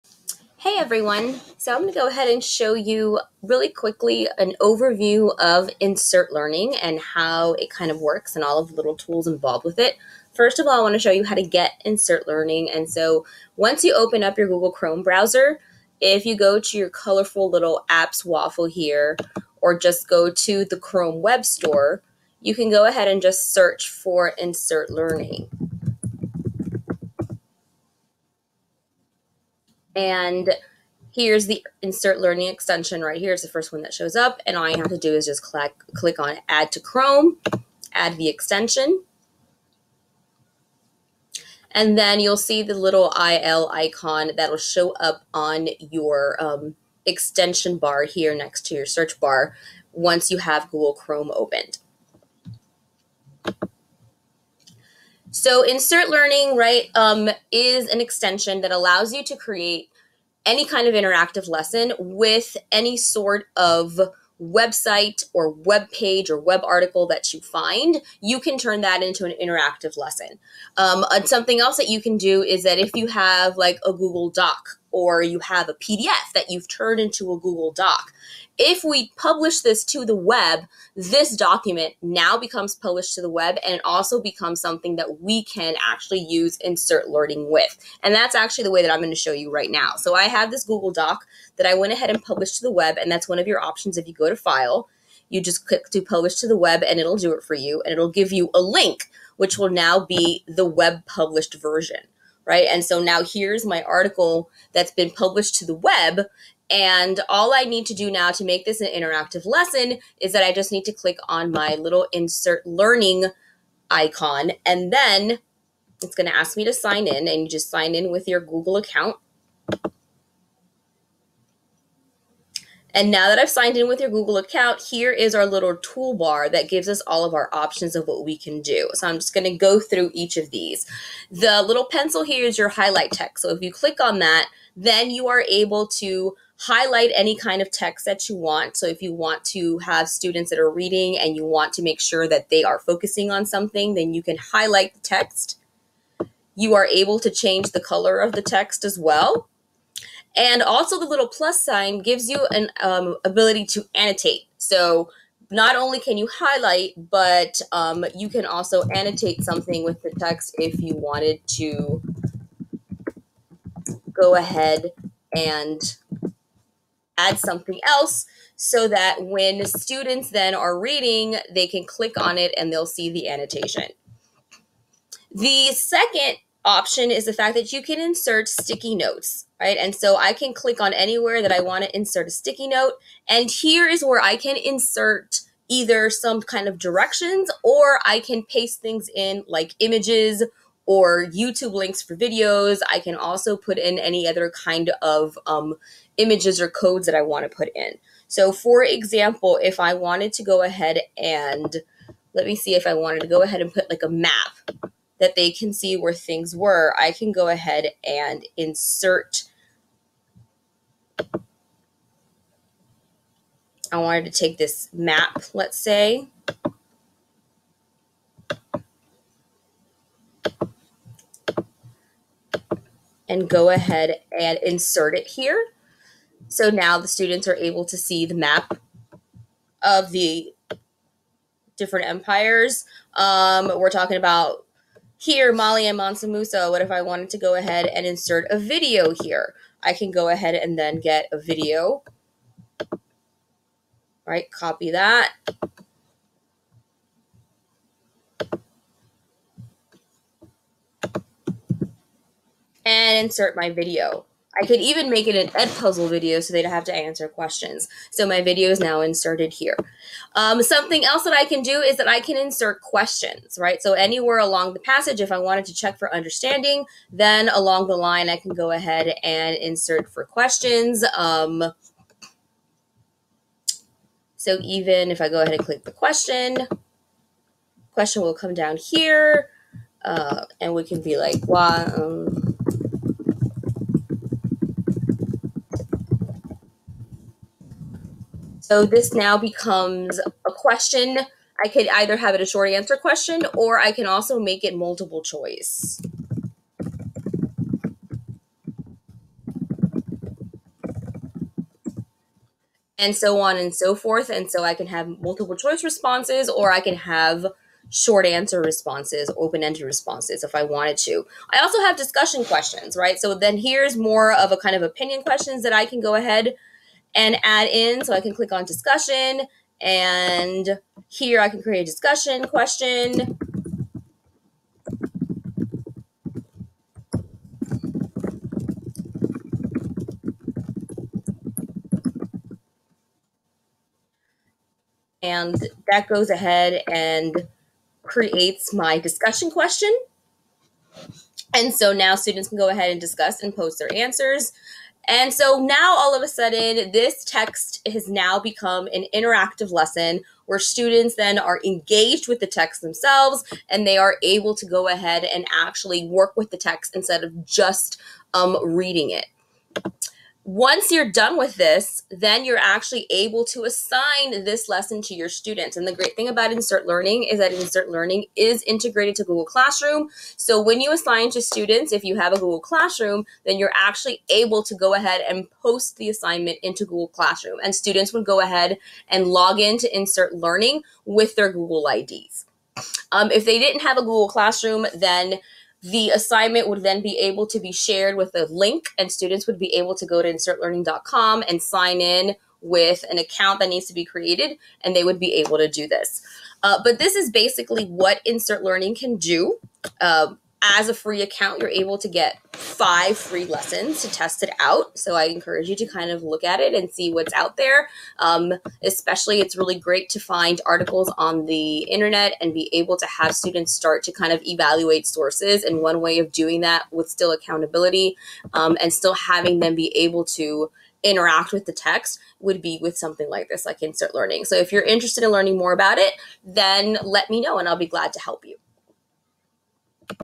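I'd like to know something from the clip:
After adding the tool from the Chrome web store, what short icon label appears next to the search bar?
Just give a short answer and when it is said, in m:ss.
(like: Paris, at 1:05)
IL, at 0:43.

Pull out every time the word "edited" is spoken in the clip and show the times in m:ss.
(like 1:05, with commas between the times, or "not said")
not said.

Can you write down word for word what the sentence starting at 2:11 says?
The little pencil here is your highlight text.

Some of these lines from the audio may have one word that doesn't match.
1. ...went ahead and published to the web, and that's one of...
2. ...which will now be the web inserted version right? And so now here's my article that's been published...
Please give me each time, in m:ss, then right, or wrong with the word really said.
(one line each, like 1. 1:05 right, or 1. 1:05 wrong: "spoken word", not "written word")
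1. 1:31 right
2. 1:39 wrong: "published", not "inserted".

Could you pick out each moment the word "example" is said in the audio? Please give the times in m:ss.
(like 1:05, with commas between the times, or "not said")
3:18.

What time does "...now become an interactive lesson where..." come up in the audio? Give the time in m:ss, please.
5:48.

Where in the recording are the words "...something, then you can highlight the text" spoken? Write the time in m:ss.
2:23.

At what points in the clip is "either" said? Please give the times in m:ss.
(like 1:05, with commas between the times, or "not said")
3:05, 4:51.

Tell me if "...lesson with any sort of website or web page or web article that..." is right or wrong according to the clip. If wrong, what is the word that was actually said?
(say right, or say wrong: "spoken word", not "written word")
right.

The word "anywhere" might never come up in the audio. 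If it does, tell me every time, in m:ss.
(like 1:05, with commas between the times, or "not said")
3:00, 4:23.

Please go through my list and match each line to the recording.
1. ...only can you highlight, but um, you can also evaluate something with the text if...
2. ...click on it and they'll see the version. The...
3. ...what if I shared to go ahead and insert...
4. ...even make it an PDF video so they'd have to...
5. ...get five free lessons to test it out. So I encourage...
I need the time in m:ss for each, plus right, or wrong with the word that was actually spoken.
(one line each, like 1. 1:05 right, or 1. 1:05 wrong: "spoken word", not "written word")
1. 2:35 wrong: "annotate", not "evaluate"
2. 2:51 wrong: "annotation", not "version"
3. 3:56 wrong: "wanted", not "shared"
4. 4:14 wrong: "Edpuzzle", not "PDF"
5. 6:42 right.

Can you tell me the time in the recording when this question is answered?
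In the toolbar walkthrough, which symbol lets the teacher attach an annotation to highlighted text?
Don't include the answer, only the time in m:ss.
2:31.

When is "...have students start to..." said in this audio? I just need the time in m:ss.
6:53.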